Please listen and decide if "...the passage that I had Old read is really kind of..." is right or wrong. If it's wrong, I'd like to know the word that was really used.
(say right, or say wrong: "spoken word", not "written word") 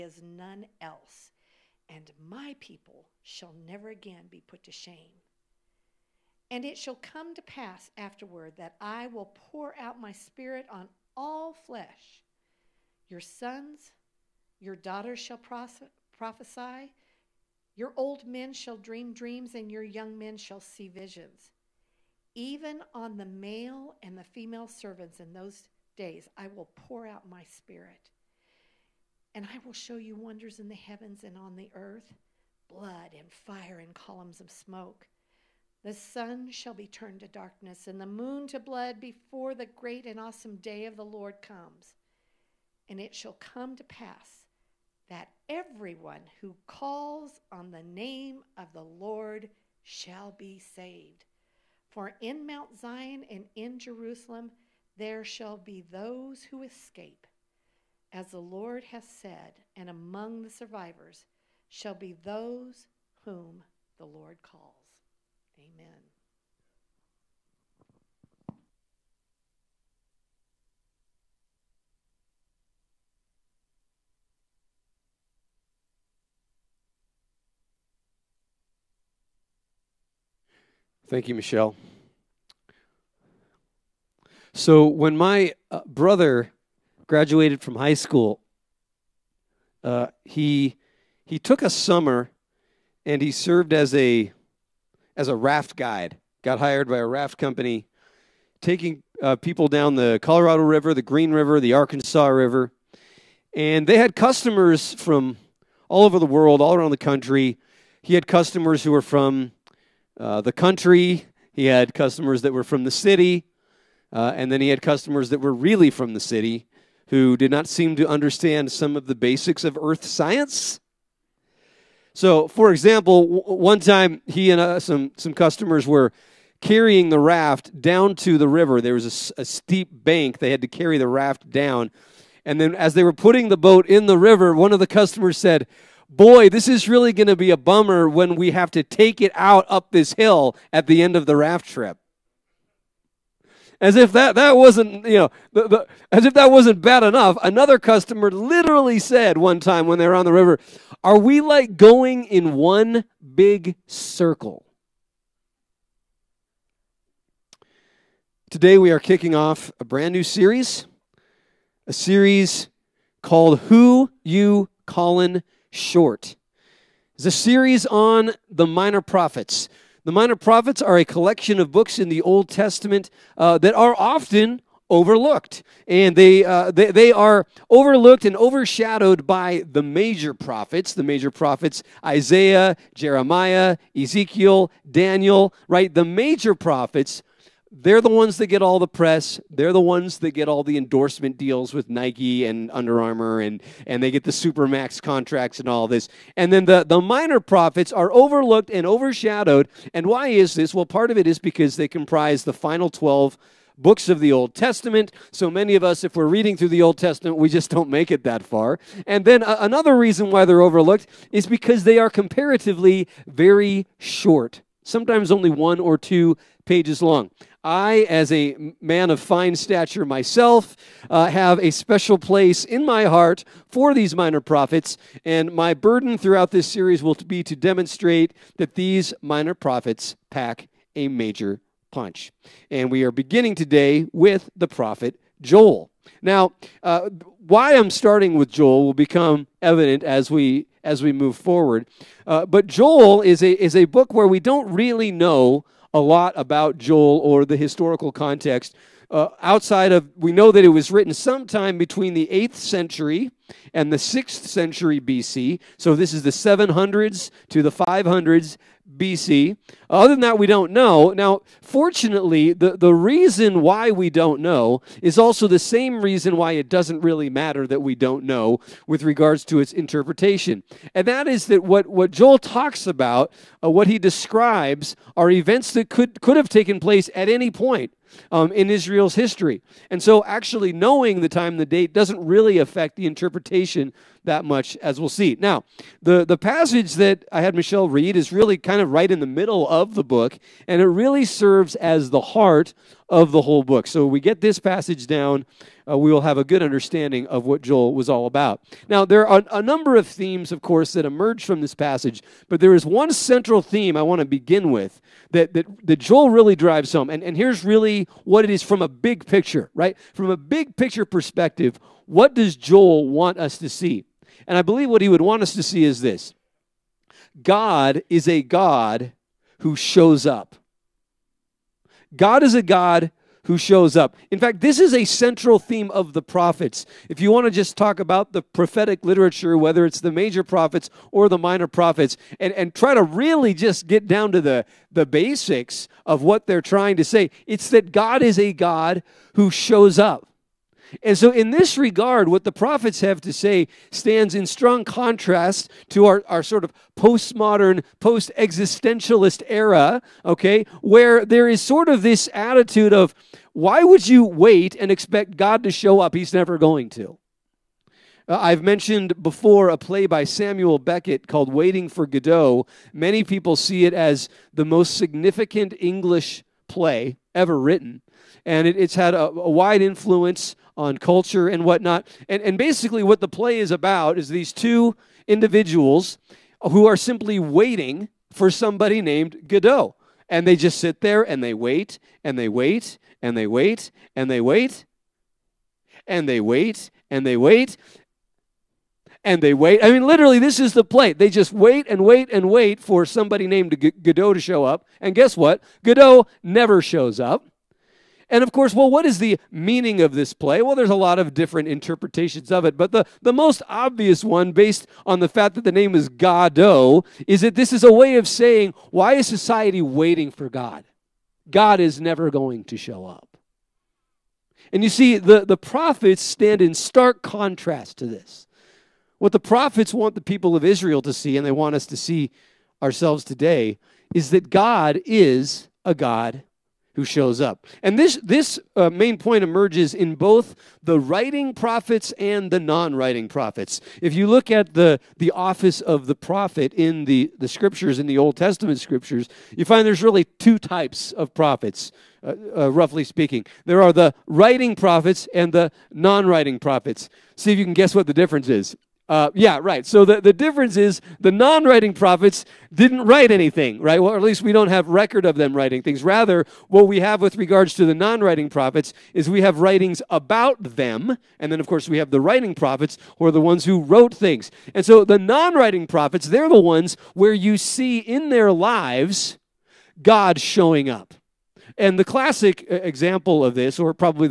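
wrong: "Michelle", not "Old".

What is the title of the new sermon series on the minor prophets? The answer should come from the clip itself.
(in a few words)
Who You Callin' Short.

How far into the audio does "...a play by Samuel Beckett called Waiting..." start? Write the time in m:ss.
5:59.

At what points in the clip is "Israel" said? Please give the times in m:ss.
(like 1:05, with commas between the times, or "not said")
4:38, 7:00.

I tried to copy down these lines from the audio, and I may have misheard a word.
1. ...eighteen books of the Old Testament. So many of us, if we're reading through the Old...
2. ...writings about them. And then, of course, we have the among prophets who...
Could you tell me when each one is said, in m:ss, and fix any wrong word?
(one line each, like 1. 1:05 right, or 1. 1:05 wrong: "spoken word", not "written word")
1. 3:22 wrong: "twelve", not "eighteen"
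2. 7:39 wrong: "writing", not "among".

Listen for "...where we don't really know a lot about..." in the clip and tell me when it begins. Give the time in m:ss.
4:04.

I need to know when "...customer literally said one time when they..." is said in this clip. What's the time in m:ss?
2:27.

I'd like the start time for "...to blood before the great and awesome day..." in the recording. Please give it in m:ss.
0:38.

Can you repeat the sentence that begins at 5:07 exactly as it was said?
And, and here's really what it is from a big picture, right?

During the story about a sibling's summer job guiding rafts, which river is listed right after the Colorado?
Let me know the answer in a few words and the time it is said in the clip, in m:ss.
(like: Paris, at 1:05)
Green River, at 1:40.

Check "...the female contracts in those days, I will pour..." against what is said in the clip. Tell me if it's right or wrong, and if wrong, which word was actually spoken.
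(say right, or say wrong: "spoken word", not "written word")
wrong: "servants", not "contracts".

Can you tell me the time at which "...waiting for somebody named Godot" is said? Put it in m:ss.
6:17.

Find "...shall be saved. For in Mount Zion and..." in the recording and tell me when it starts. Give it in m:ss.
0:49.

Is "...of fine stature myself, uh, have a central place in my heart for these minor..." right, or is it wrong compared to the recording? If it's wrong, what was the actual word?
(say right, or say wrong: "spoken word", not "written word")
wrong: "special", not "central".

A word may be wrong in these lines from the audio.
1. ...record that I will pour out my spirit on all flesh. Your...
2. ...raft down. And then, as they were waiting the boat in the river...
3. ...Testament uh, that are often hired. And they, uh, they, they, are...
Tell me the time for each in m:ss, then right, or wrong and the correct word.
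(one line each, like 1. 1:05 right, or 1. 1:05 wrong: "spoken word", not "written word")
1. 0:07 wrong: "afterward", not "record"
2. 2:11 wrong: "putting", not "waiting"
3. 2:52 wrong: "overlooked", not "hired".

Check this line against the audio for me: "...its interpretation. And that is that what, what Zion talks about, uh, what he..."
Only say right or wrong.
wrong.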